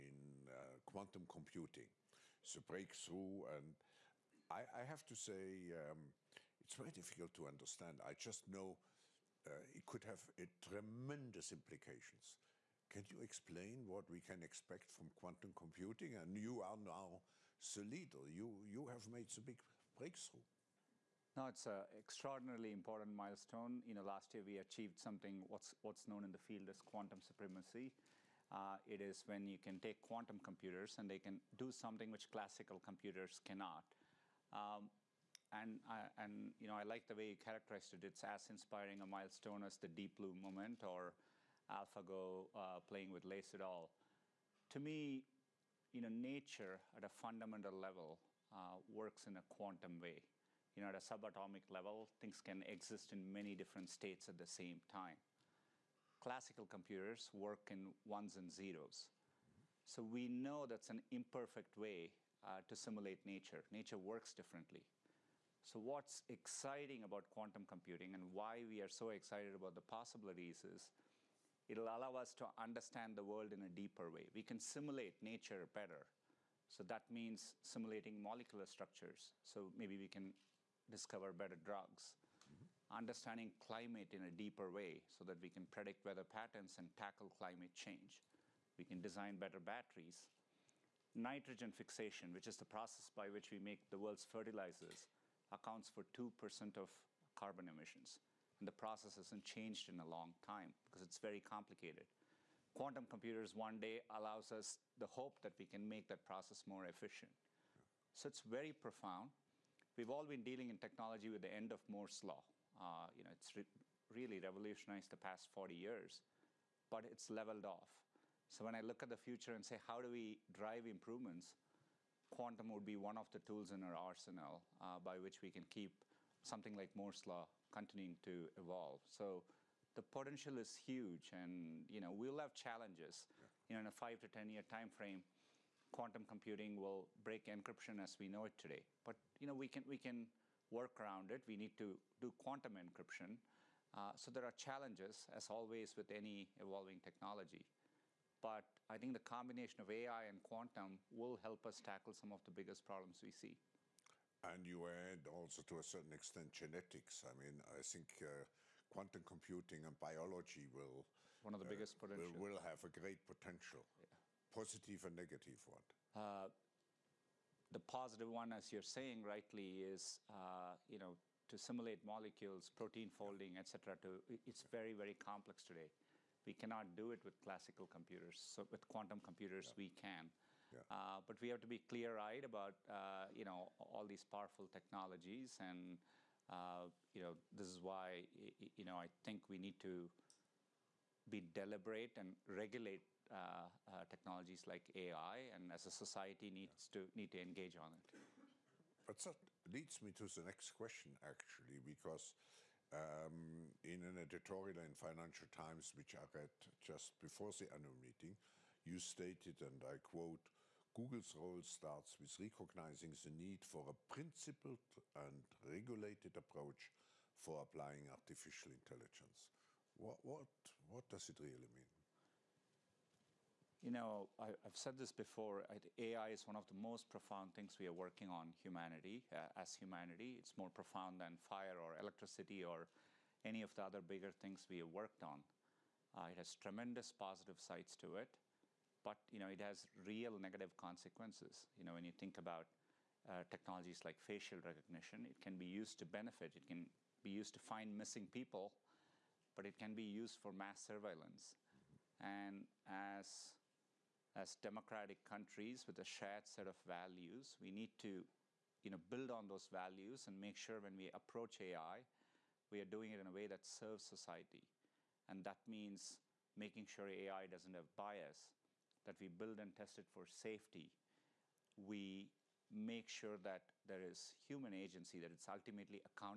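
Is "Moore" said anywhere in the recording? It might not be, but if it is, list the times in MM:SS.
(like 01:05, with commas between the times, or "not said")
01:51, 02:06.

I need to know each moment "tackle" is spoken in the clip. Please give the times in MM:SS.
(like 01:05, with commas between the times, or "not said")
01:26, 02:31.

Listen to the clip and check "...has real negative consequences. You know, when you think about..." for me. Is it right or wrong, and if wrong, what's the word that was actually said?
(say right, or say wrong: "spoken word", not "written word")
right.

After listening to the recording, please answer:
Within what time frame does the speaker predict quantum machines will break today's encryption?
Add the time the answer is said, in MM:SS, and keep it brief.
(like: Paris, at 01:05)
5 to 10 years, at 02:14.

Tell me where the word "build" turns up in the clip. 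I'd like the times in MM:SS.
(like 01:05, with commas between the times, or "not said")
04:18, 04:29.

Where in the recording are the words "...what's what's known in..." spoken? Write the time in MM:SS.
00:25.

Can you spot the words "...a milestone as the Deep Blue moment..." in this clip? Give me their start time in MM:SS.
00:39.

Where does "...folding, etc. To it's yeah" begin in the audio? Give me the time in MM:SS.
02:53.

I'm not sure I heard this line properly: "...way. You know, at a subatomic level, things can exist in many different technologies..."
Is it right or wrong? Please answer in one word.
wrong.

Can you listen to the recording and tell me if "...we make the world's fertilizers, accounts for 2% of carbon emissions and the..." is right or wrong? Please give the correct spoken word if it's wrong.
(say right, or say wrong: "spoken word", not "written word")
right.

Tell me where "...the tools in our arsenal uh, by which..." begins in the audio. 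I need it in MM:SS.
02:03.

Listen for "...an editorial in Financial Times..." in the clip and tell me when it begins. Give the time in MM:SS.
03:24.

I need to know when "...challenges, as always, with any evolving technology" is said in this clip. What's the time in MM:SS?
02:24.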